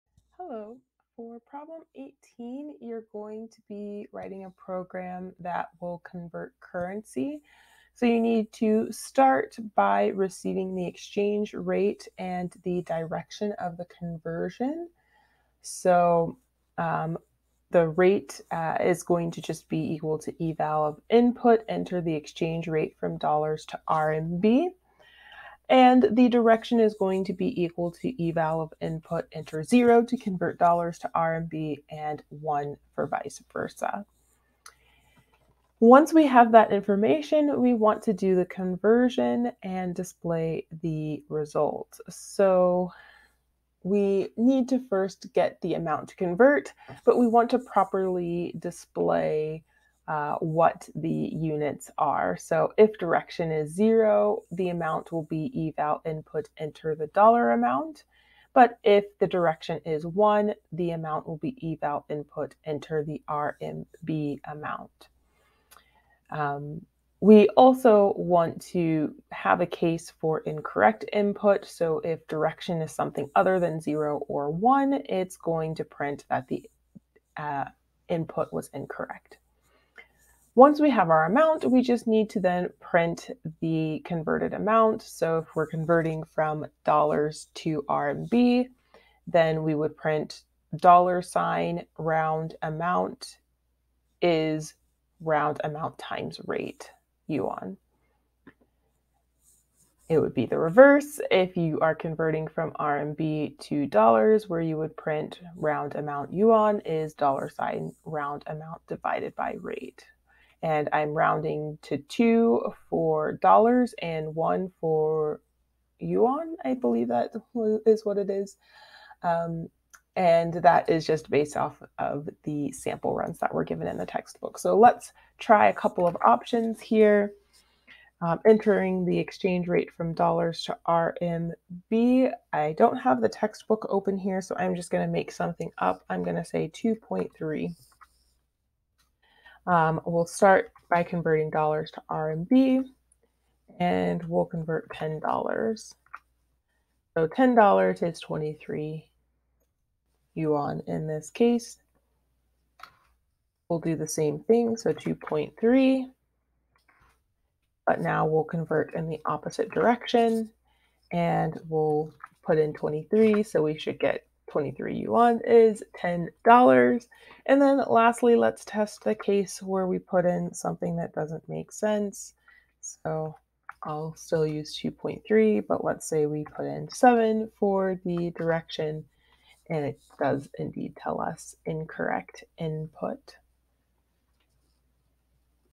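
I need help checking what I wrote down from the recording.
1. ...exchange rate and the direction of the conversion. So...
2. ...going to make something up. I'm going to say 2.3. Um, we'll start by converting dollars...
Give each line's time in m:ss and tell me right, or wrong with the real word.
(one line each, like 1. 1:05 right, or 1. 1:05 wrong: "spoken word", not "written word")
1. 0:10 right
2. 2:14 right.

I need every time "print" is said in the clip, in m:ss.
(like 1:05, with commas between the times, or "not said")
1:15, 1:22, 1:29, 1:44.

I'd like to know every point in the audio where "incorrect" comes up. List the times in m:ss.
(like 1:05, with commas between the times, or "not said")
1:10, 1:18, 3:01.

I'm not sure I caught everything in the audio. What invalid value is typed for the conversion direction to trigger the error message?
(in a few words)
7.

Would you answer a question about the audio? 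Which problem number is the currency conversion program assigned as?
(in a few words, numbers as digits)
18.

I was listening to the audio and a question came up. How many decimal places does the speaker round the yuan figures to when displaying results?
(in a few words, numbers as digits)
1.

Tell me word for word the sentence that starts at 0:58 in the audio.
But if the direction is one, the amount will be eval input enter the RMB amount.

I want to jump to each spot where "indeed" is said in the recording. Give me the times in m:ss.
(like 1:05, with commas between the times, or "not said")
3:00.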